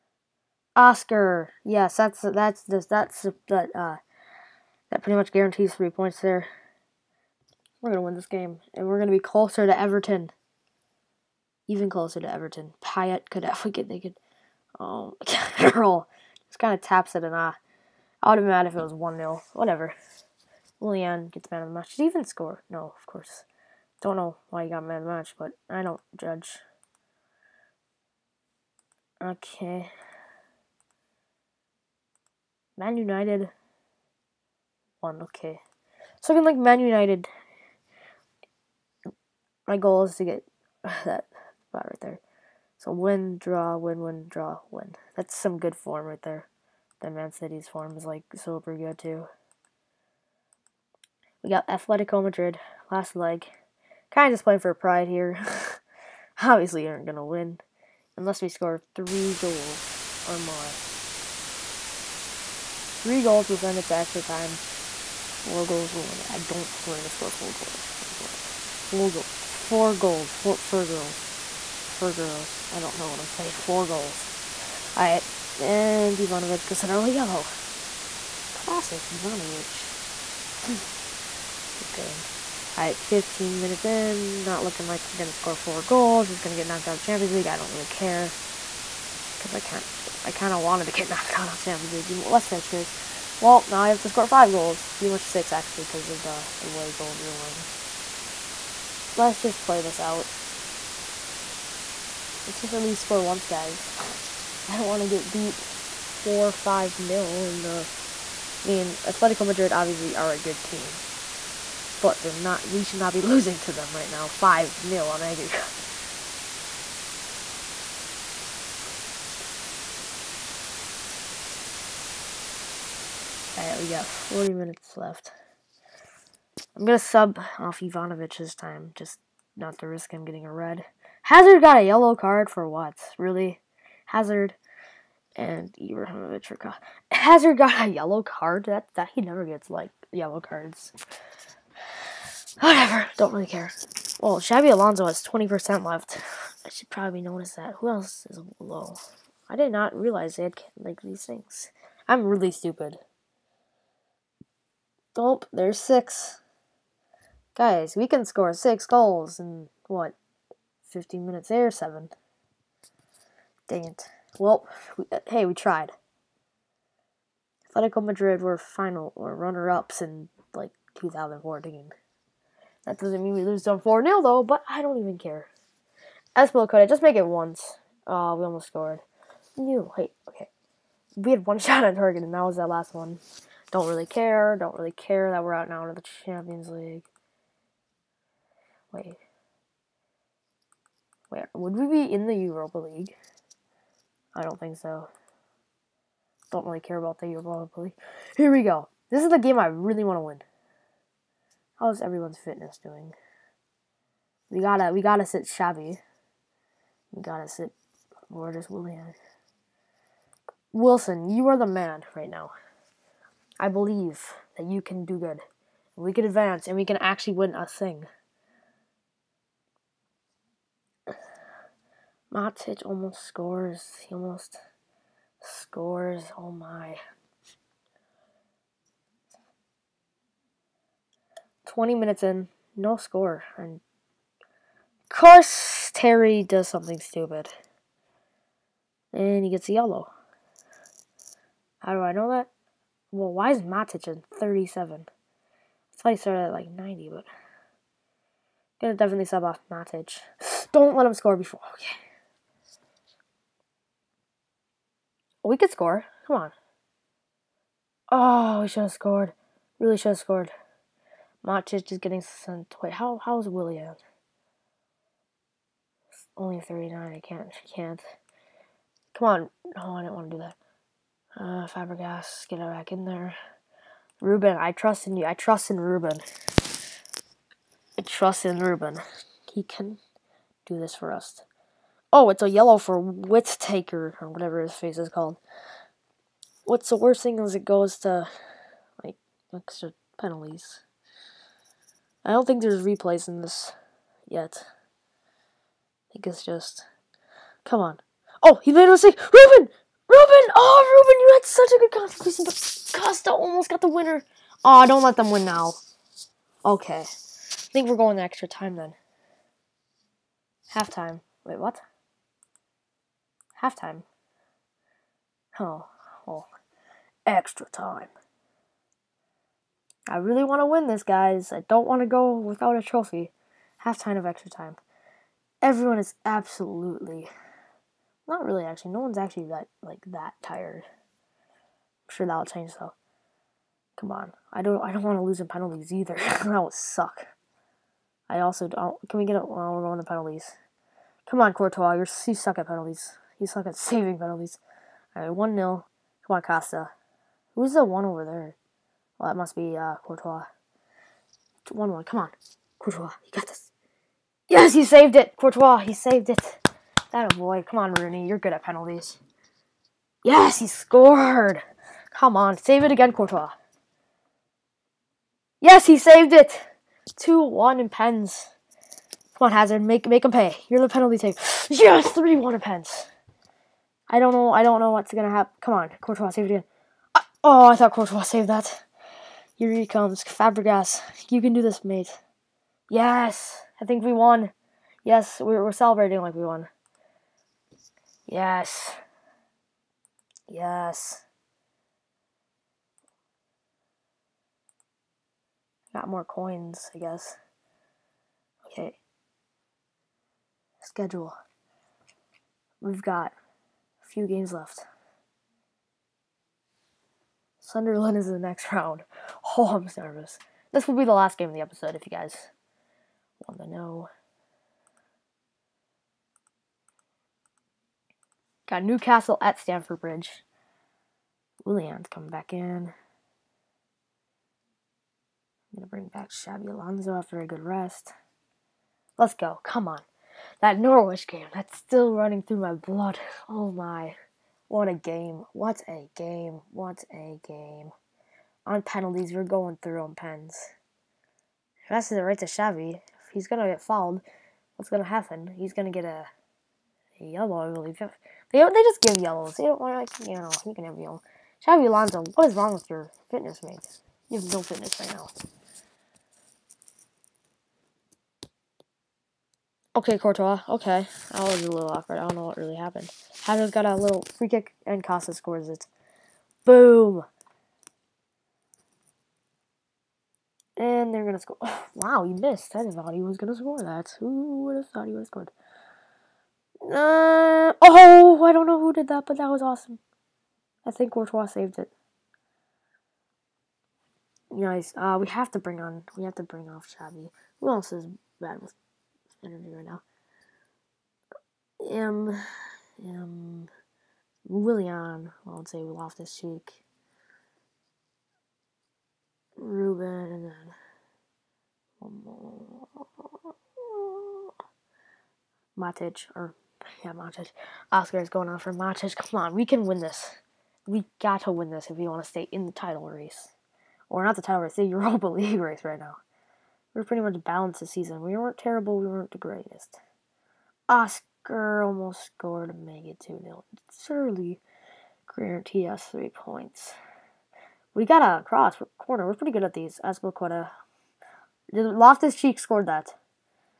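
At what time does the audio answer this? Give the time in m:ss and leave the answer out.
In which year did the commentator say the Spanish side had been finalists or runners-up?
2:50.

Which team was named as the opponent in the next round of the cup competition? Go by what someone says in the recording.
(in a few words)
Sunderland.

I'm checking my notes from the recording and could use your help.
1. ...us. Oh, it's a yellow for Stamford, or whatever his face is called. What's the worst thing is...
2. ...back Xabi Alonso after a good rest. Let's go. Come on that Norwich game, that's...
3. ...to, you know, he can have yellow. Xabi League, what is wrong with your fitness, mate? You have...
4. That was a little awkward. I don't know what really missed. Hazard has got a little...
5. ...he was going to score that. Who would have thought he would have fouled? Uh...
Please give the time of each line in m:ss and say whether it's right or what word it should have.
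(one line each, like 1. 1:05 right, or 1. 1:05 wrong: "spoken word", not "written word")
1. 4:41 wrong: "Whittaker", not "Stamford"
2. 7:06 right
3. 7:30 wrong: "Alonso", not "League"
4. 7:41 wrong: "happened", not "missed"
5. 7:53 wrong: "scored", not "fouled".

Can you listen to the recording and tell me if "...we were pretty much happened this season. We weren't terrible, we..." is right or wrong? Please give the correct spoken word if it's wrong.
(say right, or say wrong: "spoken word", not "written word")
wrong: "balanced", not "happened".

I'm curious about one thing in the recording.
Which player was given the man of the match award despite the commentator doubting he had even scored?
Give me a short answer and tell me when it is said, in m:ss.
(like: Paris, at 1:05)
Julian, at 0:20.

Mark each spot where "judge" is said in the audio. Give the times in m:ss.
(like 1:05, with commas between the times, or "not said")
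0:26.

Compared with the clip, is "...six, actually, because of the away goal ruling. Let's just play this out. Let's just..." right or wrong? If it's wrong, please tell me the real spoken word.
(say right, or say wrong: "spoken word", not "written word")
right.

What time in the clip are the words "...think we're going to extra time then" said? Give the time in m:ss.
5:07.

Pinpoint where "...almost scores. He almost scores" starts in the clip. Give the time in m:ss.
3:42.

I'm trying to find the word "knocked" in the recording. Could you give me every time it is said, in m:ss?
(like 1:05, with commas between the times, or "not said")
1:26, 1:31.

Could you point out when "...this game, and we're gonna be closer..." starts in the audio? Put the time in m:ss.
0:08.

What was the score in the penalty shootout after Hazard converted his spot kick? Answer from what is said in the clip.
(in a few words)
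3-1.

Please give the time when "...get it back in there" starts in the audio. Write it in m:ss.
4:32.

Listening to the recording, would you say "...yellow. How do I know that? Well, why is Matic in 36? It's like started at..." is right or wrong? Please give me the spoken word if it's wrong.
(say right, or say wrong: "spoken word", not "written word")
wrong: "37", not "36".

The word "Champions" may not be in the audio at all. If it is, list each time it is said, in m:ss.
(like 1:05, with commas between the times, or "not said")
1:26, 1:31, 3:06.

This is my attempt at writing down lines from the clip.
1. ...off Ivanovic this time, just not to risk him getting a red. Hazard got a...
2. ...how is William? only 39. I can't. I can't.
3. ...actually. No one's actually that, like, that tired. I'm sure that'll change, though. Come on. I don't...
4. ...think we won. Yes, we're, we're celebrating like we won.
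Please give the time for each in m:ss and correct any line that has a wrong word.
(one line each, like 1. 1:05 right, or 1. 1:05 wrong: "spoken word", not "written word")
1. 2:07 right
2. 4:23 right
3. 5:28 right
4. 6:23 right.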